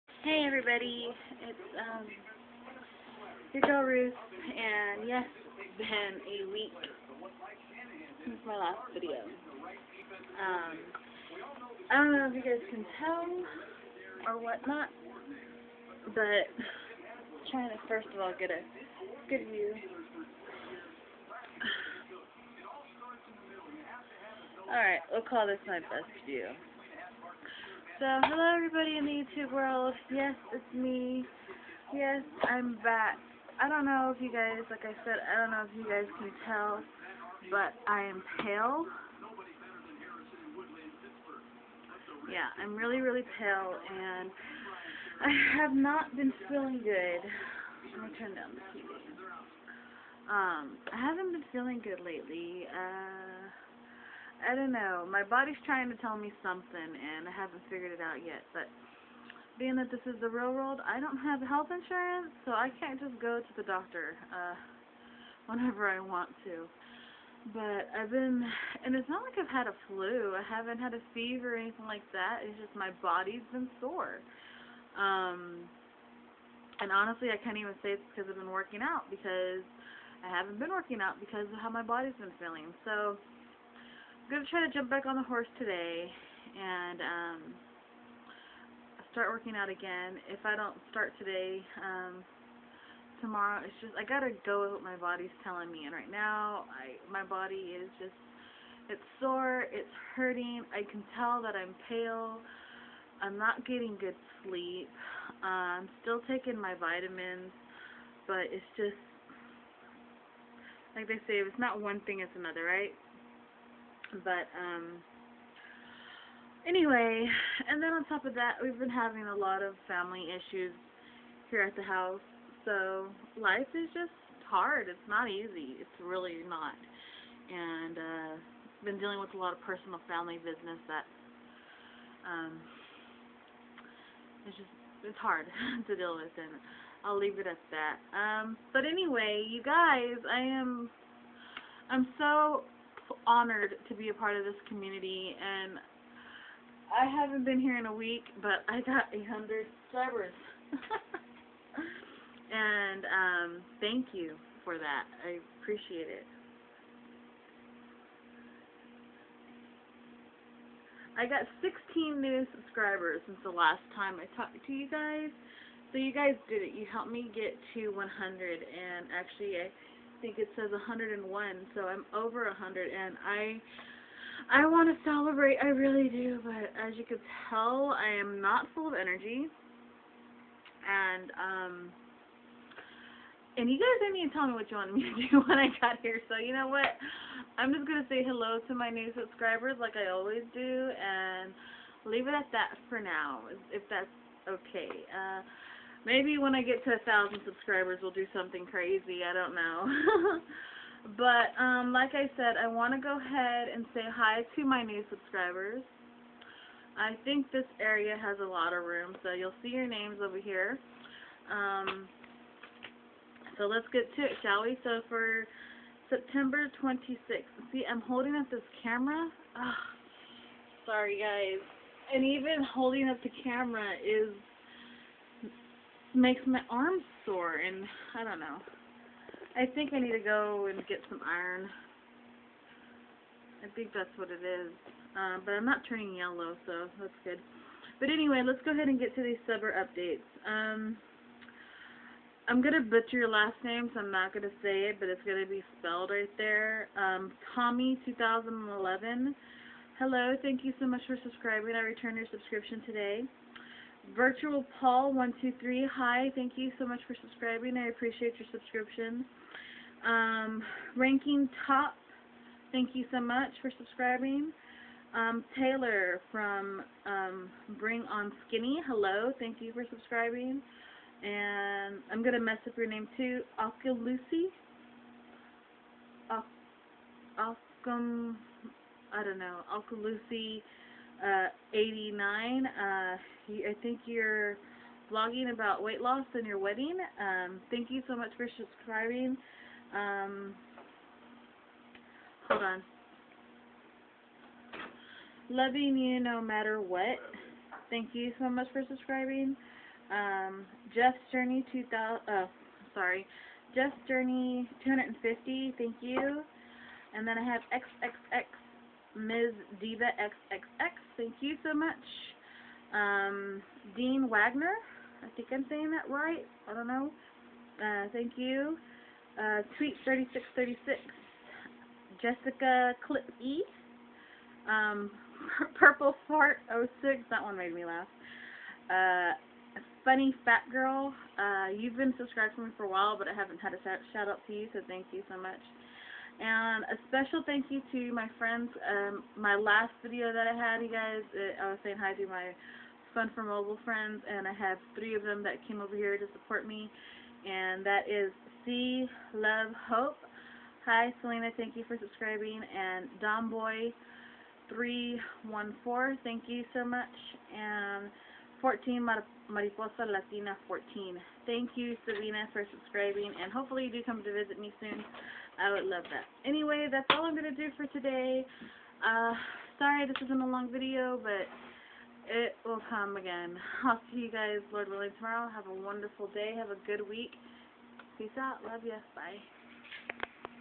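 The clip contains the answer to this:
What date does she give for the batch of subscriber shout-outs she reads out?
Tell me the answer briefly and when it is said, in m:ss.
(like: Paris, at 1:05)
September 26th, at 3:36.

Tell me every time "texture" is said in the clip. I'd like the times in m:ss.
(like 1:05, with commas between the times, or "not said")
not said.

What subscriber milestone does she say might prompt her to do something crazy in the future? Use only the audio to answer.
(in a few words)
a thousand.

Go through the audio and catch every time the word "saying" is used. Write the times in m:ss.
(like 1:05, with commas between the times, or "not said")
5:15, 5:41.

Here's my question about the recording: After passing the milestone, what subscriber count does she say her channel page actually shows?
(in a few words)
101.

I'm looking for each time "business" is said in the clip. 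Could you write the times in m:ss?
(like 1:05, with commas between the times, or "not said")
2:10.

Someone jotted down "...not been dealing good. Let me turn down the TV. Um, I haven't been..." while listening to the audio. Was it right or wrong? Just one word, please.
wrong.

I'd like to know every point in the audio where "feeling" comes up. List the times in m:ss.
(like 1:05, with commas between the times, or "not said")
0:46, 0:51, 1:22.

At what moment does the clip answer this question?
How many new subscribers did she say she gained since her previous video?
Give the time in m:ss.
2:41.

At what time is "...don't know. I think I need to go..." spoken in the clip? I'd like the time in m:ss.
3:48.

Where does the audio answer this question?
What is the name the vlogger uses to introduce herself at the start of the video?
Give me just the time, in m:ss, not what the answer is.
0:03.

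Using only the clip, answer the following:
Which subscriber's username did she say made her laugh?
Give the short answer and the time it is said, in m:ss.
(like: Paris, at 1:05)
Purple Fart 06, at 5:25.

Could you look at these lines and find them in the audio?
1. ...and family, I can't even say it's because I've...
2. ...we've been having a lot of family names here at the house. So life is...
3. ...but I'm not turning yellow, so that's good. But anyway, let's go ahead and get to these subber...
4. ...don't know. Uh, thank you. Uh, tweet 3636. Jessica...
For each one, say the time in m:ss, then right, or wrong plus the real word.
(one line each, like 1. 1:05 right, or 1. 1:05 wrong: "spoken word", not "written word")
1. 1:16 wrong: "honestly", not "family"
2. 1:58 wrong: "issues", not "names"
3. 3:55 right
4. 5:16 right.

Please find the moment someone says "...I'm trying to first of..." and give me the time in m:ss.
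0:16.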